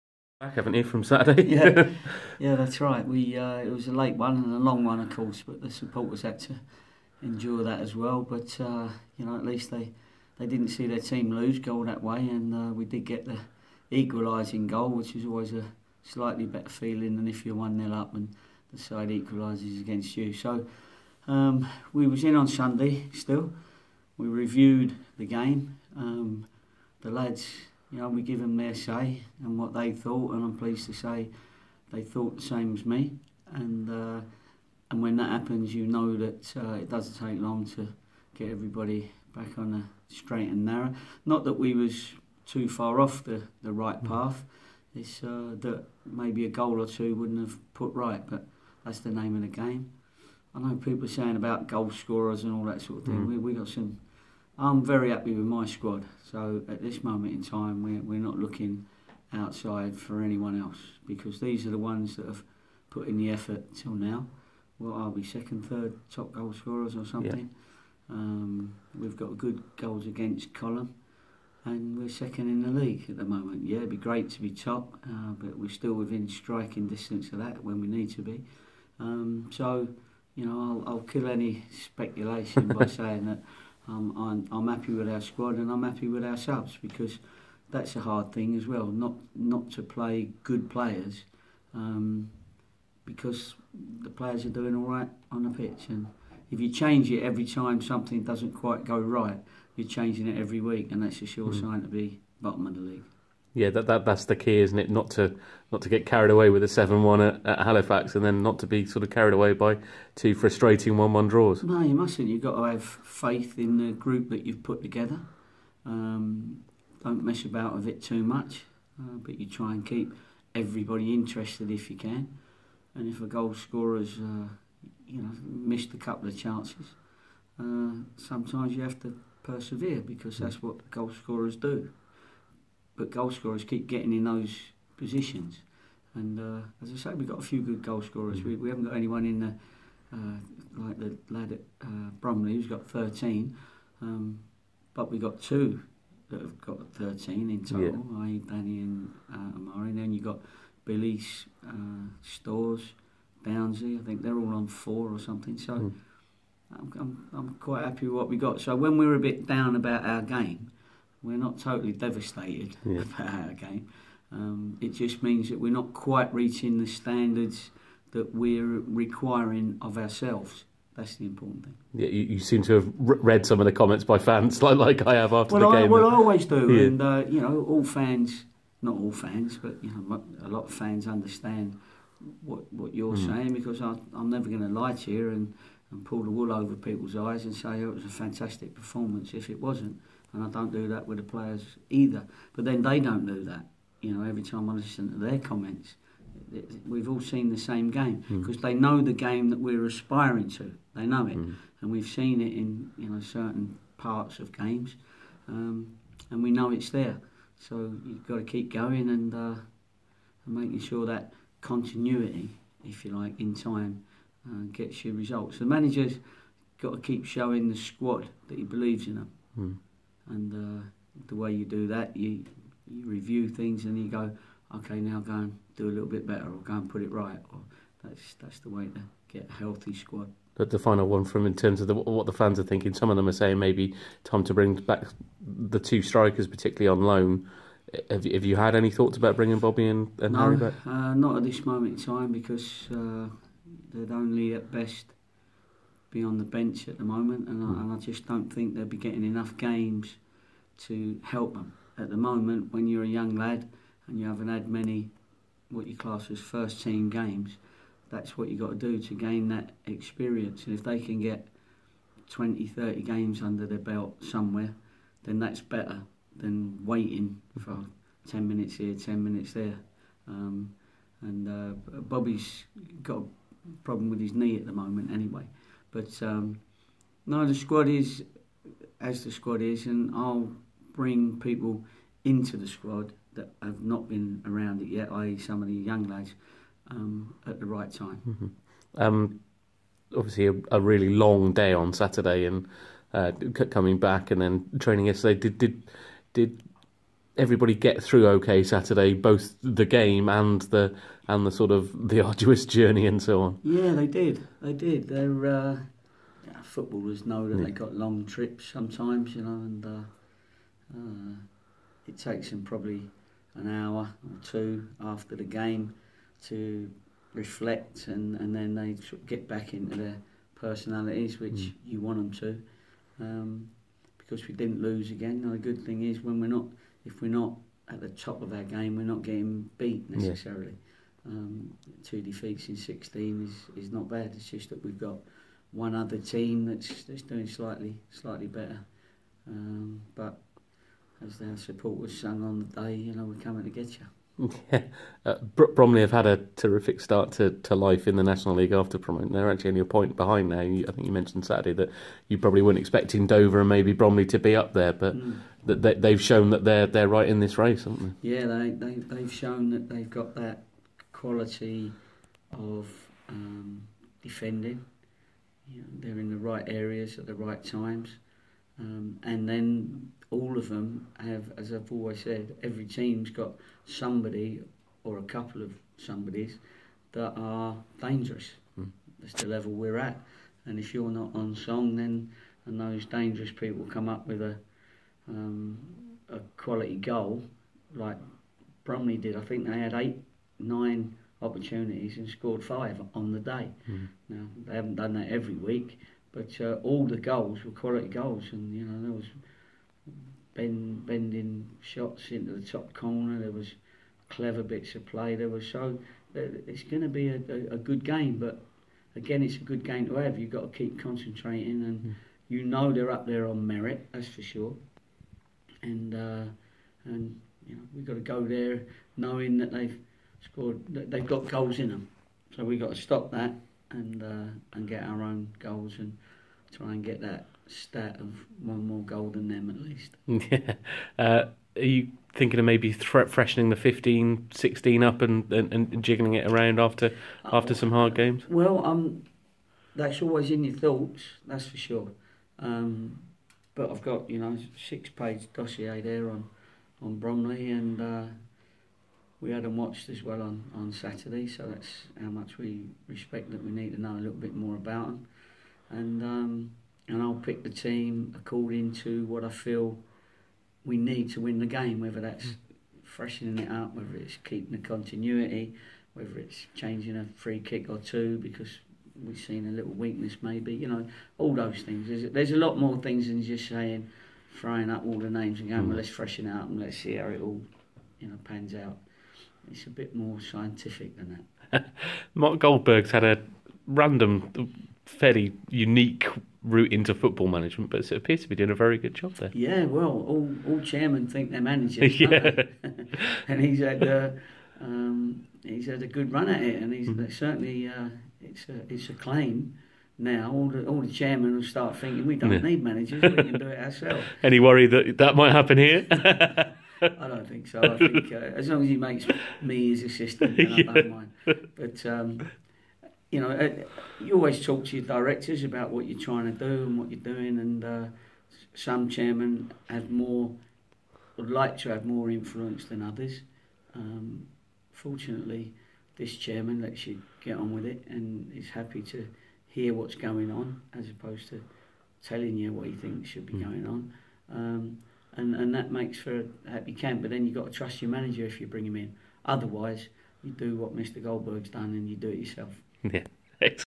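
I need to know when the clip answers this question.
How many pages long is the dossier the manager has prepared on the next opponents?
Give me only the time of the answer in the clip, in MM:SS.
07:24.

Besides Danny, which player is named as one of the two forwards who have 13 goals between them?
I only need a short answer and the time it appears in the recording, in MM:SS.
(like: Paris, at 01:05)
Amari, at 02:29.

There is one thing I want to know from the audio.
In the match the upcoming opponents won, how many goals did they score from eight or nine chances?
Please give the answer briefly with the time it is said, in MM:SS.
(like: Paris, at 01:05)
5, at 06:32.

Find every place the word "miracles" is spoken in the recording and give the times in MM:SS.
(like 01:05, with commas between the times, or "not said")
not said.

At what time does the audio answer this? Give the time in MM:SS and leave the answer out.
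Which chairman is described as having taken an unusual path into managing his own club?
08:02.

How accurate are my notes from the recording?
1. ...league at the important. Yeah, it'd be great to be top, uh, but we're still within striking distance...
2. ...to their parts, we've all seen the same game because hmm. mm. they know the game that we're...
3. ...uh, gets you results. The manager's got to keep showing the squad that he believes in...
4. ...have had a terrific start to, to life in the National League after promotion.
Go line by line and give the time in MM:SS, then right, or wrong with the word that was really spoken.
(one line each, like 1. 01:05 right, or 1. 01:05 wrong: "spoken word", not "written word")
1. 01:12 wrong: "moment", not "important"
2. 03:15 wrong: "comments", not "parts"
3. 03:34 right
4. 05:46 right.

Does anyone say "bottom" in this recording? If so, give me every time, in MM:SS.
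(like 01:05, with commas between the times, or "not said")
01:42.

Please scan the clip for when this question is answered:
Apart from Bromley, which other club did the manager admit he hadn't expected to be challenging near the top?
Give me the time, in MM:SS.
05:53.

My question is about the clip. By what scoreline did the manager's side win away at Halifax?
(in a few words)
7-1.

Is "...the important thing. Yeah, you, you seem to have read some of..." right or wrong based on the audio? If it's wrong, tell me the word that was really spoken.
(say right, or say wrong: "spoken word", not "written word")
right.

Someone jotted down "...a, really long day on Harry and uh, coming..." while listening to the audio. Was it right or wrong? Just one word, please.
wrong.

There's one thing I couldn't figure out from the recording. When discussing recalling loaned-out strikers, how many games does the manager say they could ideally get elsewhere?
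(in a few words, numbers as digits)
20-30.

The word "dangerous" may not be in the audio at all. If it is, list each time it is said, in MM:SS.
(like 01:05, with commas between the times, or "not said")
06:18, 06:23.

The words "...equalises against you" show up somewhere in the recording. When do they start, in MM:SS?
00:19.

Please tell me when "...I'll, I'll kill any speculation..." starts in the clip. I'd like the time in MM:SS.
01:20.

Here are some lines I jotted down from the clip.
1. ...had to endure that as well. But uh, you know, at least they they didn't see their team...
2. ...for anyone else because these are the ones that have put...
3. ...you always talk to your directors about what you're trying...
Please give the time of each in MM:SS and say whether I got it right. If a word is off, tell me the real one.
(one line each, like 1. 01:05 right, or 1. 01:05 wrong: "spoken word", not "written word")
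1. 00:06 right
2. 00:59 right
3. 08:34 right.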